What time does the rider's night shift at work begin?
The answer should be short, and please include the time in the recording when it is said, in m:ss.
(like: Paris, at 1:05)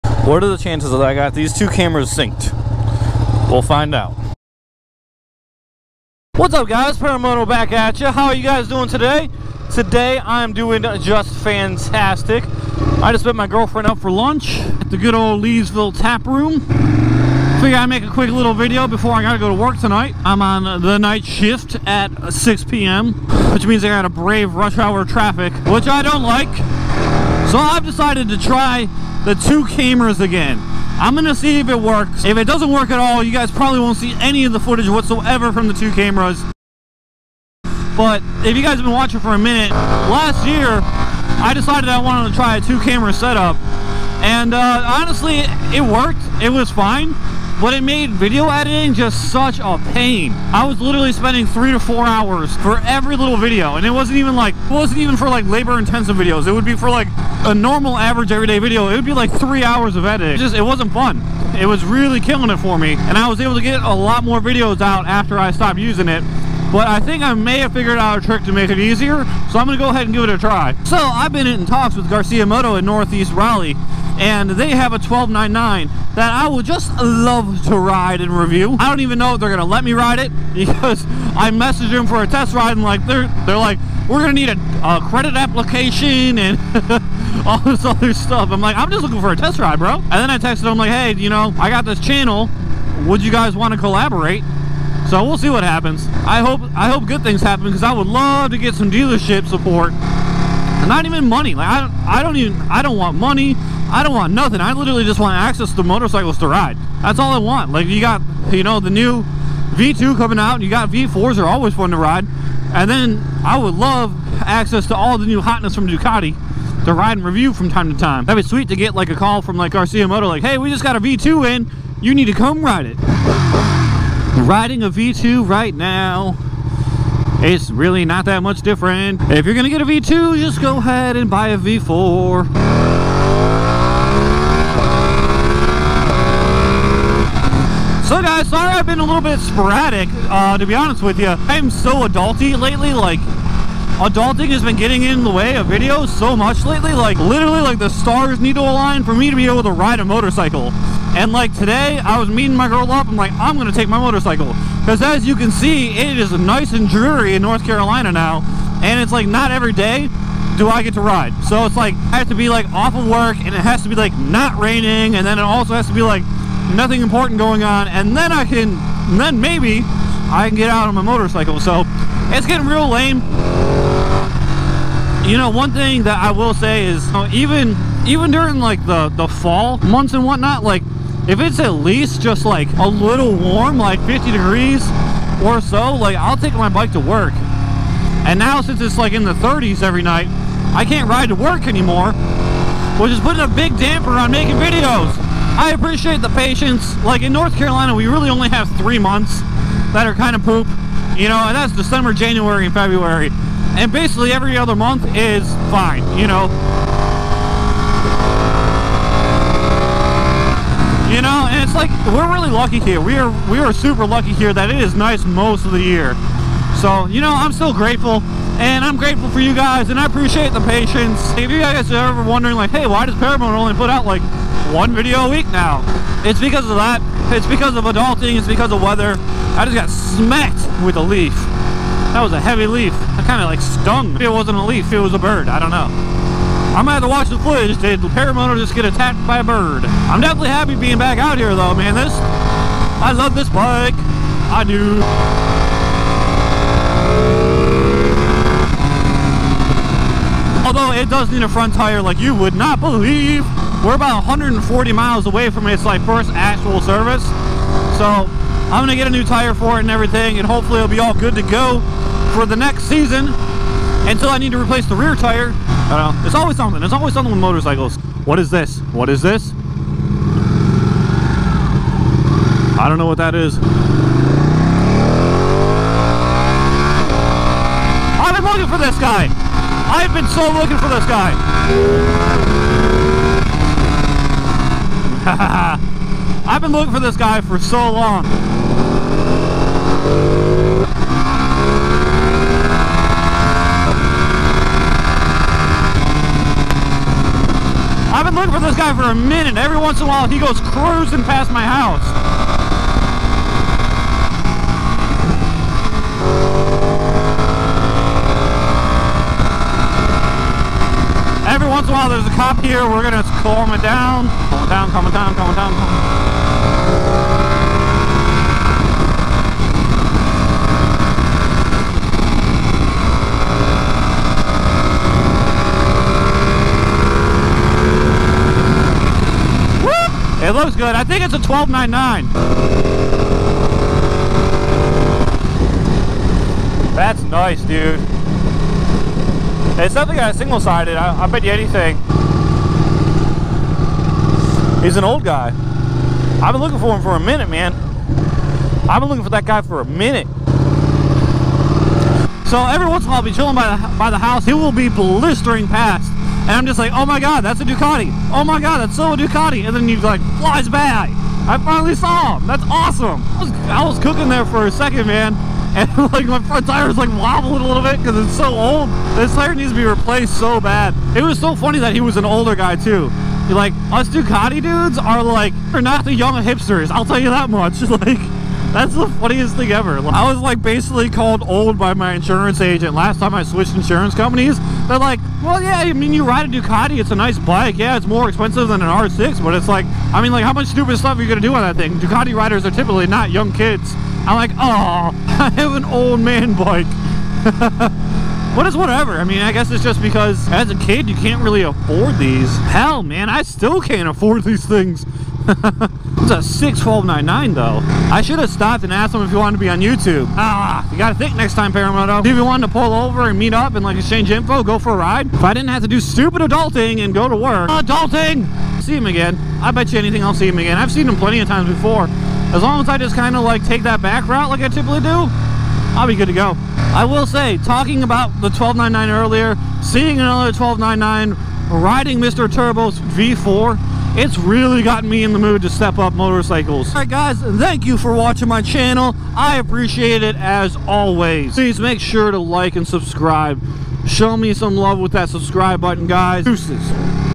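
6 p.m., at 0:22.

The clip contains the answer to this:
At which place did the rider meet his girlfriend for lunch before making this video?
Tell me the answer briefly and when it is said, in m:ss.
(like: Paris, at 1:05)
Leesville Tap Room, at 0:15.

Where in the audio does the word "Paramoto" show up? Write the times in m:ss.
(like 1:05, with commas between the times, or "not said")
0:06, 3:43, 3:58, 6:51.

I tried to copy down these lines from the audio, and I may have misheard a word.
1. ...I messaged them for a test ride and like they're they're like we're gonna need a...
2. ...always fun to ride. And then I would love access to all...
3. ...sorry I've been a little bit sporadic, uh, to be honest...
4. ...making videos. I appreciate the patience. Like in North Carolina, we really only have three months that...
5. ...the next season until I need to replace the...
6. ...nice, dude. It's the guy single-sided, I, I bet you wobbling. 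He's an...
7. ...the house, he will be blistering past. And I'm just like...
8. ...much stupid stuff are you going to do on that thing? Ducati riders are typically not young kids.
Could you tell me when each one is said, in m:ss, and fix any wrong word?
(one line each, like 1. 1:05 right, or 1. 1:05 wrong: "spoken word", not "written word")
1. 1:21 right
2. 1:51 right
3. 2:18 right
4. 3:14 right
5. 4:22 right
6. 5:37 wrong: "anything", not "wobbling"
7. 5:54 right
8. 6:30 right.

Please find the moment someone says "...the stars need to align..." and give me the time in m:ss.
2:27.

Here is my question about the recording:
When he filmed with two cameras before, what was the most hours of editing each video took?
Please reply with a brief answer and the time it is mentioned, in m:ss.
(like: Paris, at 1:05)
4, at 0:51.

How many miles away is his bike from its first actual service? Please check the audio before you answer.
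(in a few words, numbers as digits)
140.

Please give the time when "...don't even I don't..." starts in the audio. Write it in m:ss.
1:42.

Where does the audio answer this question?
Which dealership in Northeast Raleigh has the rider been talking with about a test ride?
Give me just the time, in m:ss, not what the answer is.
1:12.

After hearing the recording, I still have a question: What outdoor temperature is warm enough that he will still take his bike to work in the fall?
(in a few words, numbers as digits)
50 degrees.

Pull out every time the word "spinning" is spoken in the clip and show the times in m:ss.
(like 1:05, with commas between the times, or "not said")
not said.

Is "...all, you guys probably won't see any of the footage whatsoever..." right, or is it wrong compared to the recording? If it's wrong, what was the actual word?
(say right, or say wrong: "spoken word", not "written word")
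right.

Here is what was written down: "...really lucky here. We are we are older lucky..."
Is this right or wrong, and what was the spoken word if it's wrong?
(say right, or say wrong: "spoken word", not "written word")
wrong: "super", not "older".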